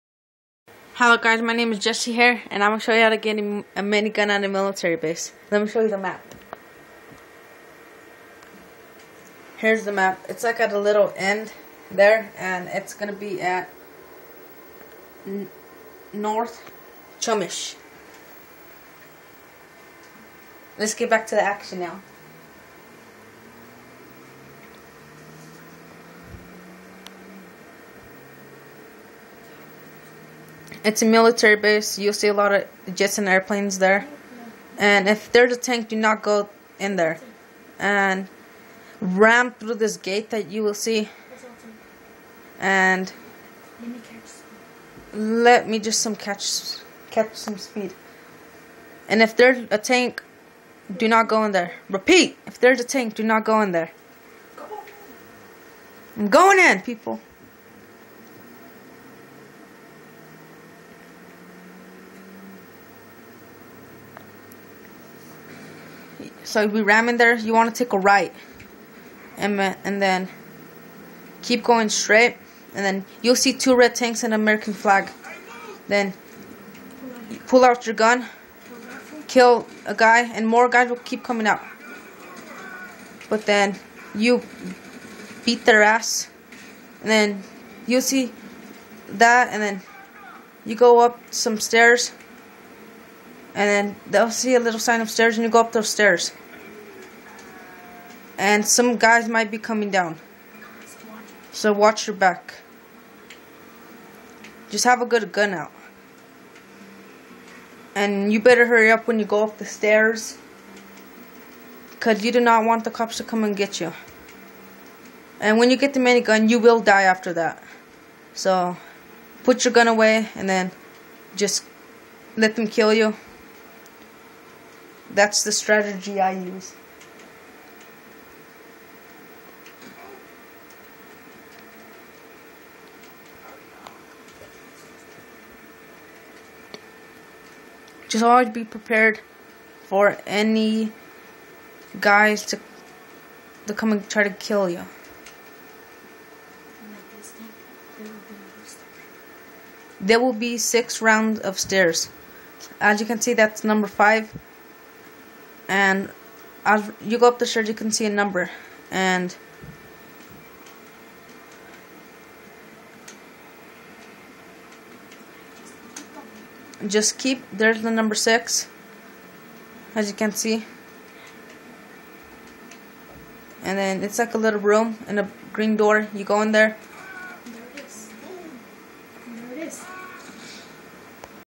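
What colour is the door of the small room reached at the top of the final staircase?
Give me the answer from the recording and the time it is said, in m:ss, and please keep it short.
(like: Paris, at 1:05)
Green, at 2:55.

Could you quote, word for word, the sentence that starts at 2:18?
Just always be prepared for any guys to to come and try to kill you.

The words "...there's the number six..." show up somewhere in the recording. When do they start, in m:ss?
2:47.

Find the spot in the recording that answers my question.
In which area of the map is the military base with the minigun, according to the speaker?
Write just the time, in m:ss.
0:16.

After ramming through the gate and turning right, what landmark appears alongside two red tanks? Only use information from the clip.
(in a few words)
An American flag.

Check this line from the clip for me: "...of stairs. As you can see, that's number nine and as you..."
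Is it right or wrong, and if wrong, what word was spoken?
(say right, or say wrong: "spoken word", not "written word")
wrong: "five", not "nine".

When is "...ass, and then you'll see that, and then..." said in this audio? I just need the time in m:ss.
1:25.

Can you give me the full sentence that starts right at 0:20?
Let's get back to the action now.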